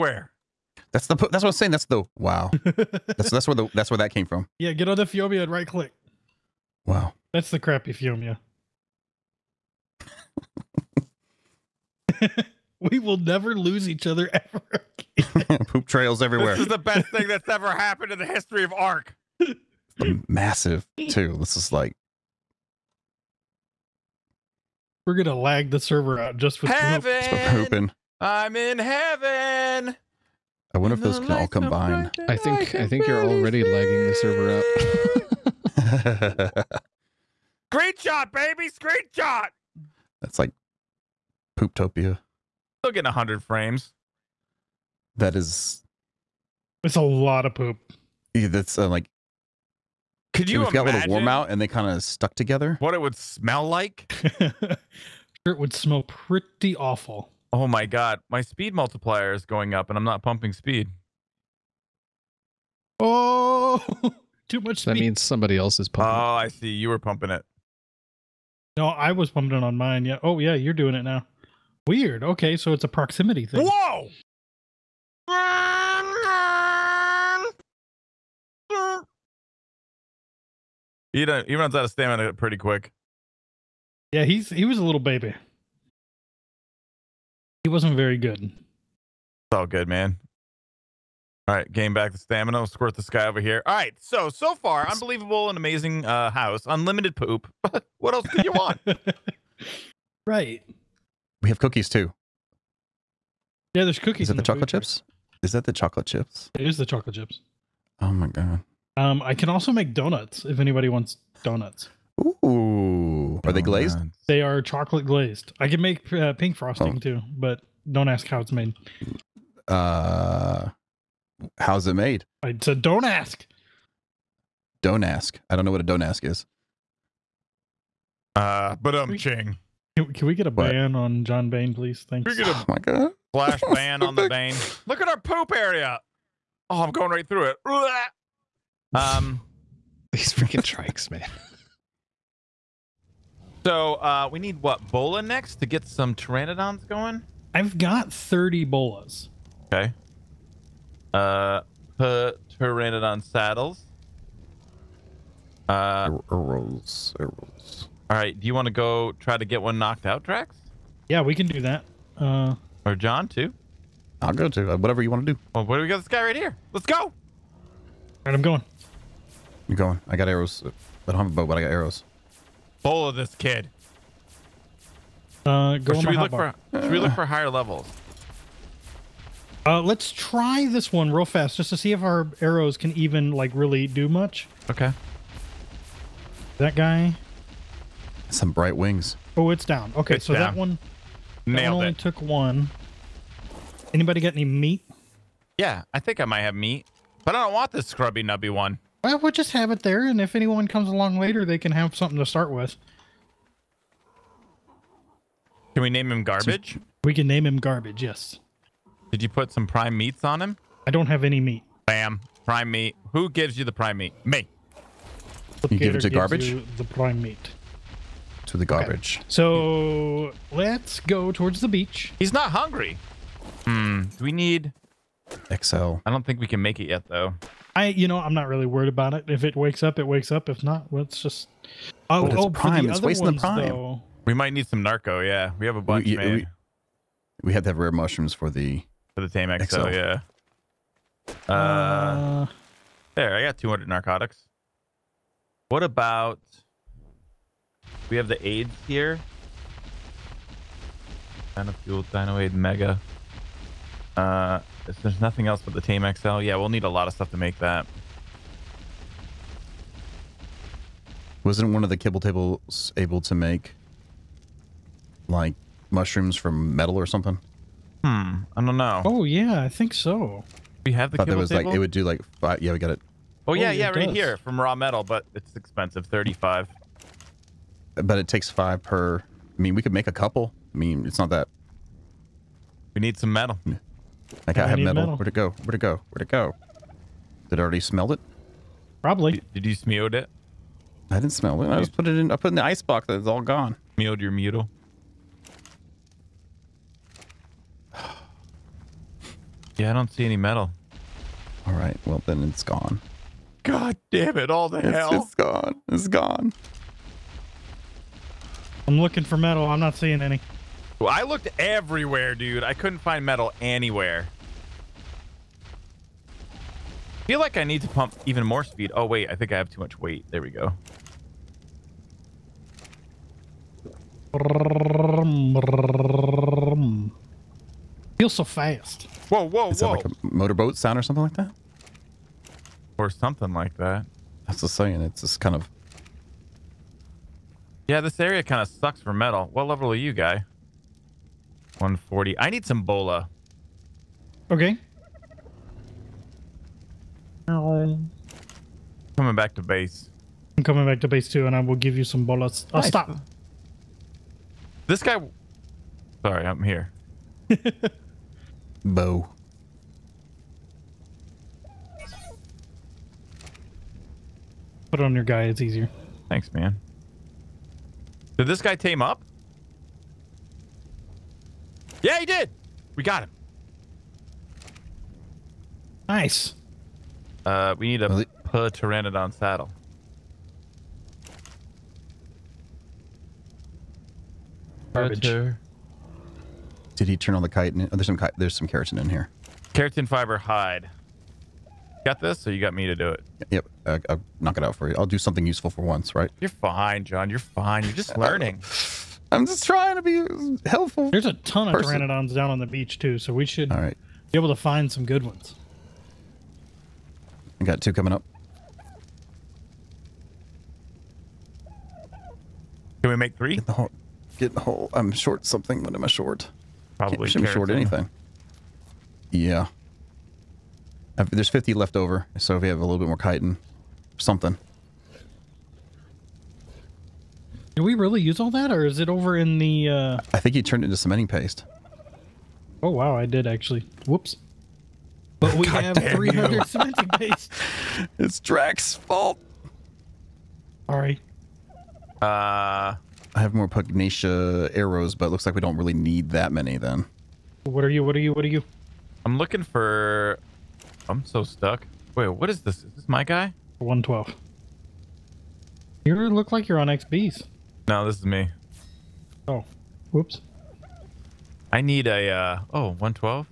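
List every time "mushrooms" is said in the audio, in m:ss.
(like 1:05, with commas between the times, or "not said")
3:57, 4:25.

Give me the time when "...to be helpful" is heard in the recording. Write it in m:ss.
6:39.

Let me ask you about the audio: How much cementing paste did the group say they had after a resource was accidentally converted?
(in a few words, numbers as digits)
300.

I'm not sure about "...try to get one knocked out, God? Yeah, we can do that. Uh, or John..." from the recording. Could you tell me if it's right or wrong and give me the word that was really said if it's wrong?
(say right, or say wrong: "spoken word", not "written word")
wrong: "Drax", not "God".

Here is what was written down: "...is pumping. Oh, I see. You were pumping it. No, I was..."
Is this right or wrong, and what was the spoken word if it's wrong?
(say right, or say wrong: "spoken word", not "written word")
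right.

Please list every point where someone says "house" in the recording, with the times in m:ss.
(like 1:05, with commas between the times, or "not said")
1:36.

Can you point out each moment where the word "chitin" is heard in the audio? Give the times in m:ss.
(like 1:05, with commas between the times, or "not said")
6:27, 7:03.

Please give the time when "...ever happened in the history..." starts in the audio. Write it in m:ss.
0:17.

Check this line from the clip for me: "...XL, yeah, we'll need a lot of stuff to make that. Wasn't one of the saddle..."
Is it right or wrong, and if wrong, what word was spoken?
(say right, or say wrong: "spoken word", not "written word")
wrong: "kibble", not "saddle".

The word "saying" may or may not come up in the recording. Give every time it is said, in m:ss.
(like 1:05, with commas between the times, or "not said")
0:01, 5:34.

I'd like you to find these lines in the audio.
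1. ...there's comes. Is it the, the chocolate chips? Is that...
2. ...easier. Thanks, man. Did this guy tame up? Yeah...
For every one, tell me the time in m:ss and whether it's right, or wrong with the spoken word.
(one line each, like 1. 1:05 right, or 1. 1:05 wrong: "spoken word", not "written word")
1. 1:43 wrong: "cookies", not "comes"
2. 6:05 right.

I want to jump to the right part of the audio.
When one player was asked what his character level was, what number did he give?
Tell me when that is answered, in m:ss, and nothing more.
5:41.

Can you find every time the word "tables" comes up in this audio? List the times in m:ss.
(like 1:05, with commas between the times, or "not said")
4:22, 4:31.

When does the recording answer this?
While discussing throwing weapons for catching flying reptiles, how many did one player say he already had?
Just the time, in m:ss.
2:28.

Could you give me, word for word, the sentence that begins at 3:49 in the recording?
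If it wakes up, it wakes up.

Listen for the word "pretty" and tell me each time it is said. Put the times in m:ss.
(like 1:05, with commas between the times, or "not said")
0:56, 1:22.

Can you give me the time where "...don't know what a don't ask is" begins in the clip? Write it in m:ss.
2:05.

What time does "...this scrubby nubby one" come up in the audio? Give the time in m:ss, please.
3:17.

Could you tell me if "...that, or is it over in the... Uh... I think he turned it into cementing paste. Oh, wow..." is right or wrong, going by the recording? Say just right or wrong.
right.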